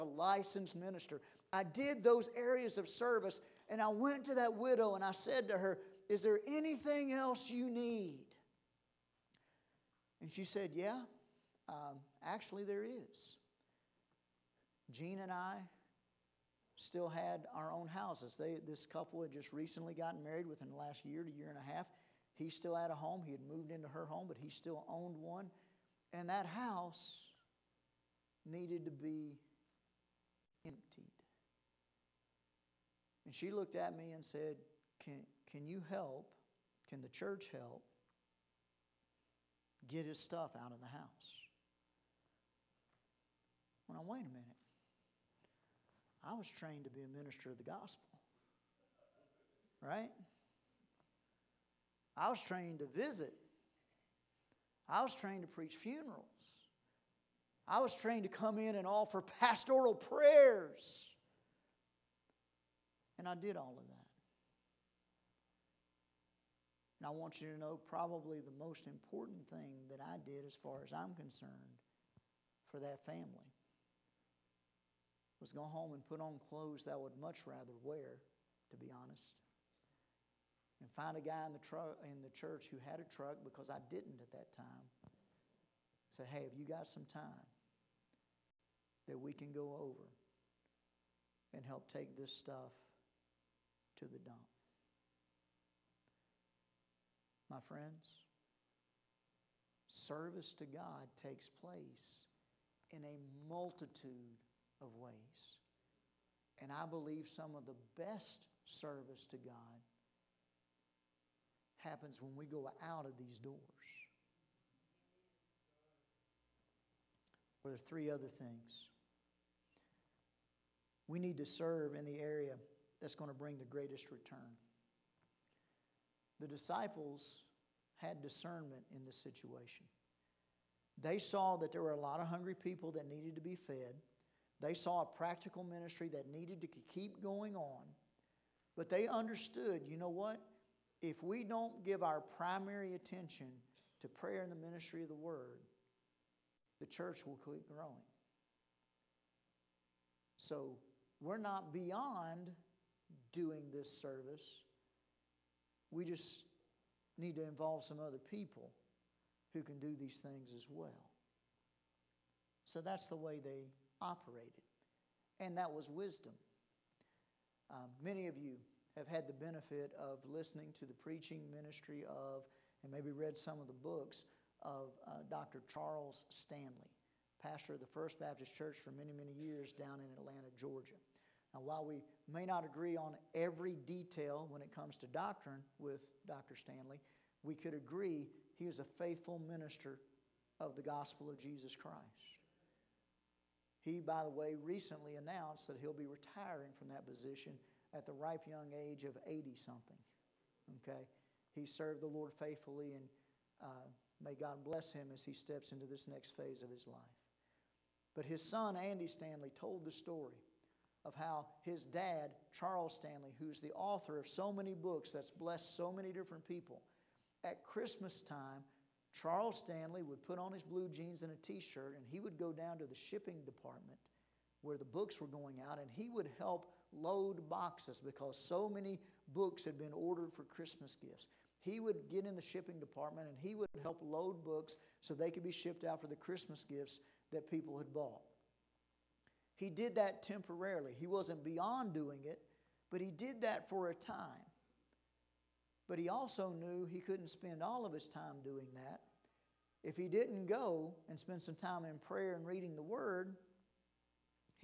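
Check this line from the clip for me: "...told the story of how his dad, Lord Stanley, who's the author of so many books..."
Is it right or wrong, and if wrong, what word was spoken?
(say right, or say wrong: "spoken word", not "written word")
wrong: "Charles", not "Lord".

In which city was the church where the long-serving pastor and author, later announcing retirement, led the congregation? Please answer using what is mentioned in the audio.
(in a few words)
Atlanta.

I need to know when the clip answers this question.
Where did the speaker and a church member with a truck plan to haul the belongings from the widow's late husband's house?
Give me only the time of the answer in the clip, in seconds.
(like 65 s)
94 s.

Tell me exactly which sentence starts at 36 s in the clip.
Can the church help get his stuff out of the house?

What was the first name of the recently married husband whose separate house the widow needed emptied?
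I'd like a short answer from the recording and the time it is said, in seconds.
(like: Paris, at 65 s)
Gene, at 14 s.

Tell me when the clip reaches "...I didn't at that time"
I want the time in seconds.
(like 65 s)
83 s.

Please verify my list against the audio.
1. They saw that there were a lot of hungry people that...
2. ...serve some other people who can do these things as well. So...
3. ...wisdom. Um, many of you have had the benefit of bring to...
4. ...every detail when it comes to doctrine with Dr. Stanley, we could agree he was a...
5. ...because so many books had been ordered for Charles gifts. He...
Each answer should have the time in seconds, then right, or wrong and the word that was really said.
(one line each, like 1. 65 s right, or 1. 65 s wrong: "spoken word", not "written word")
1. 131 s right
2. 157 s wrong: "involve", not "serve"
3. 165 s wrong: "listening", not "bring"
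4. 183 s right
5. 228 s wrong: "Christmas", not "Charles".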